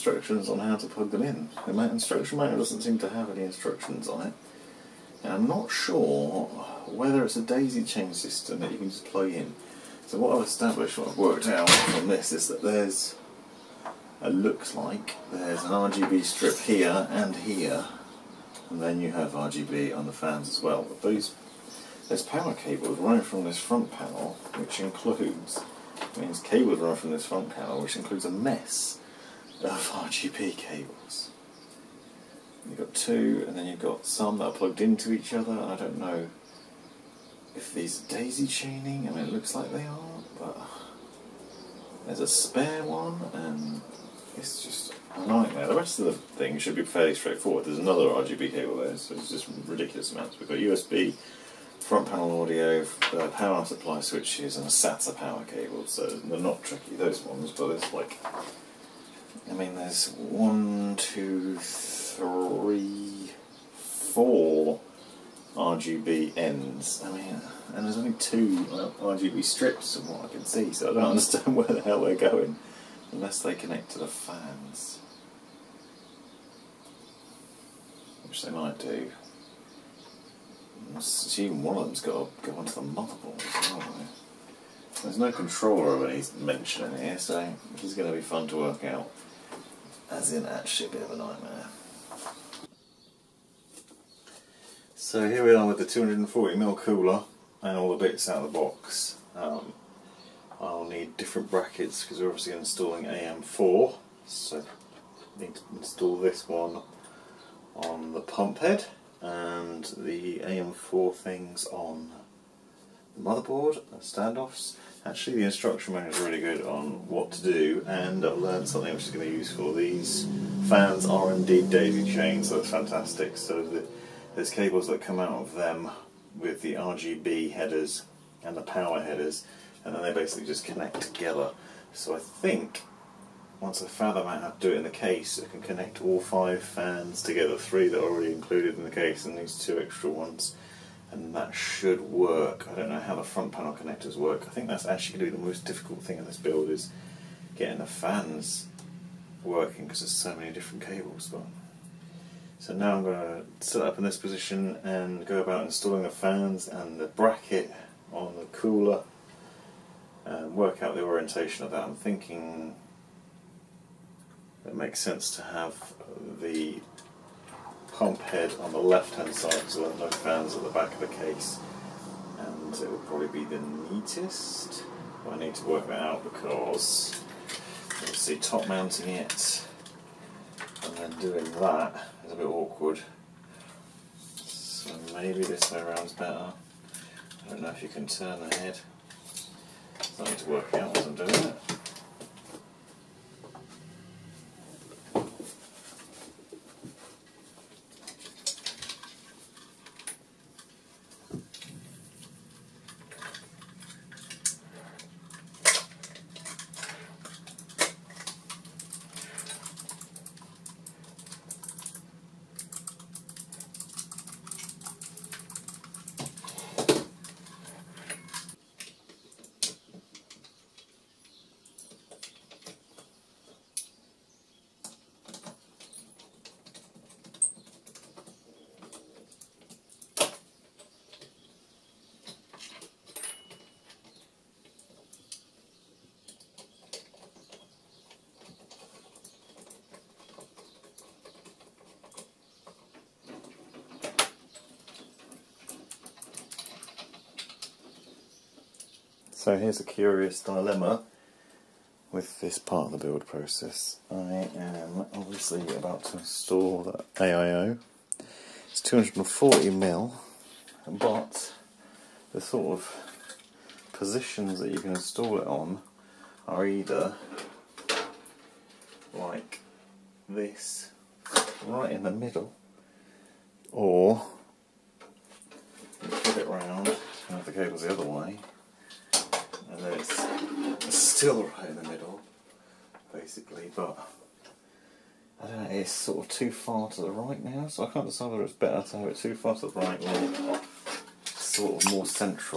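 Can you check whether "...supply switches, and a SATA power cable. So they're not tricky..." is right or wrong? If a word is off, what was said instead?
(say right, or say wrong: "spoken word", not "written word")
right.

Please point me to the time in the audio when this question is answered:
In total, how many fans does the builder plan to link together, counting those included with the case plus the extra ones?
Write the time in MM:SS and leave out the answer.
02:16.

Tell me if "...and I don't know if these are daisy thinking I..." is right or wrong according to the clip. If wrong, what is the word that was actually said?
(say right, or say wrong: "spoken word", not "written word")
wrong: "chaining", not "thinking".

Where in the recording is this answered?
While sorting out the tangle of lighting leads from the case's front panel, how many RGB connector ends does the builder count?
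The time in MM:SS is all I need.
01:03.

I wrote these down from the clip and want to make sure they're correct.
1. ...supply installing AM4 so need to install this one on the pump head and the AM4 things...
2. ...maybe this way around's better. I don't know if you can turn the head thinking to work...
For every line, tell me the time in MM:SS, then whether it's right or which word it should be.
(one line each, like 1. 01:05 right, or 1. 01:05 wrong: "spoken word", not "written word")
1. 01:42 wrong: "obviously", not "supply"
2. 03:05 wrong: "starting", not "thinking".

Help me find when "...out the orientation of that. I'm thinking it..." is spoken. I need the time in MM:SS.
02:40.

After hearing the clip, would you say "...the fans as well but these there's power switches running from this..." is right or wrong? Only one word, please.
wrong.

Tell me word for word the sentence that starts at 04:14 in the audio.
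I am obviously about to install the AIO.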